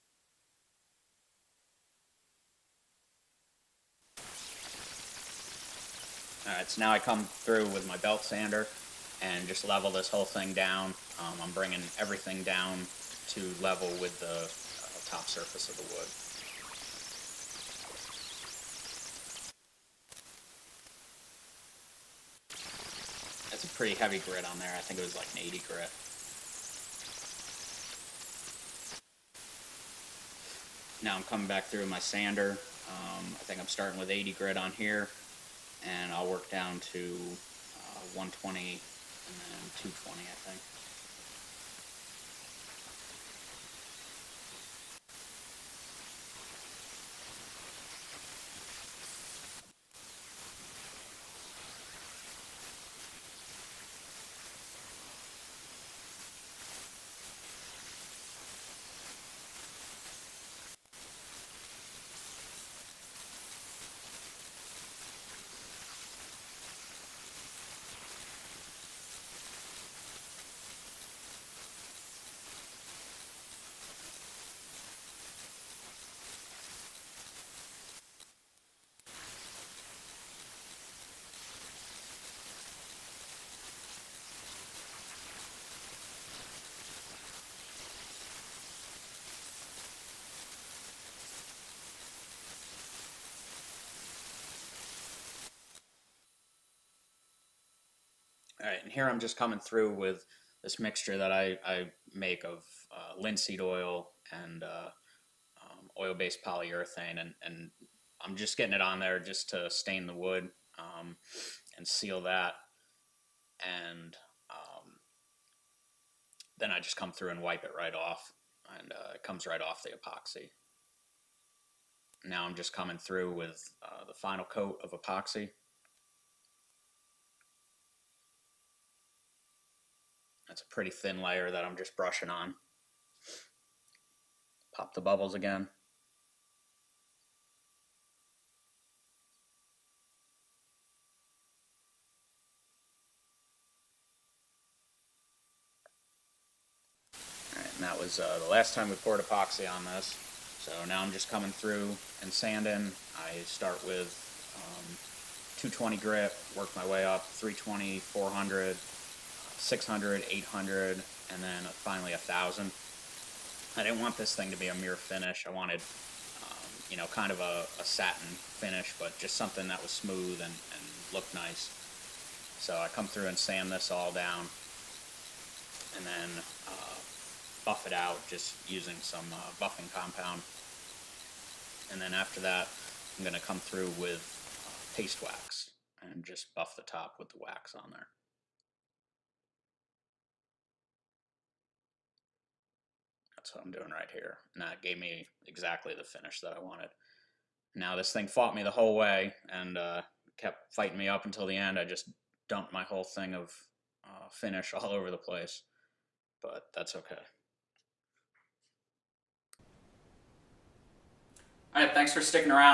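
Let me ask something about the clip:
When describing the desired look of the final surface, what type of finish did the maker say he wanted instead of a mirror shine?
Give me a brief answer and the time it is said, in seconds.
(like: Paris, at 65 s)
satin finish, at 167 s.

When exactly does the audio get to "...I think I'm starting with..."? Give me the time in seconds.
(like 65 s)
33 s.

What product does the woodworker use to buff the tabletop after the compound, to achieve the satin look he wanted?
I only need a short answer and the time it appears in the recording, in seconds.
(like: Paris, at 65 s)
paste wax, at 184 s.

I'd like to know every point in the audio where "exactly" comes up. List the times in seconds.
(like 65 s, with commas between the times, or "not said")
195 s.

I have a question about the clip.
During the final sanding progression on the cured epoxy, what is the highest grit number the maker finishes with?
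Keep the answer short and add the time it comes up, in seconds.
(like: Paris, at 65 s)
1000, at 162 s.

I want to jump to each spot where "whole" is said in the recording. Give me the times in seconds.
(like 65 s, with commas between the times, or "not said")
10 s, 198 s, 202 s.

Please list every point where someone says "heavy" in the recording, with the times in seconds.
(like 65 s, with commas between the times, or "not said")
23 s.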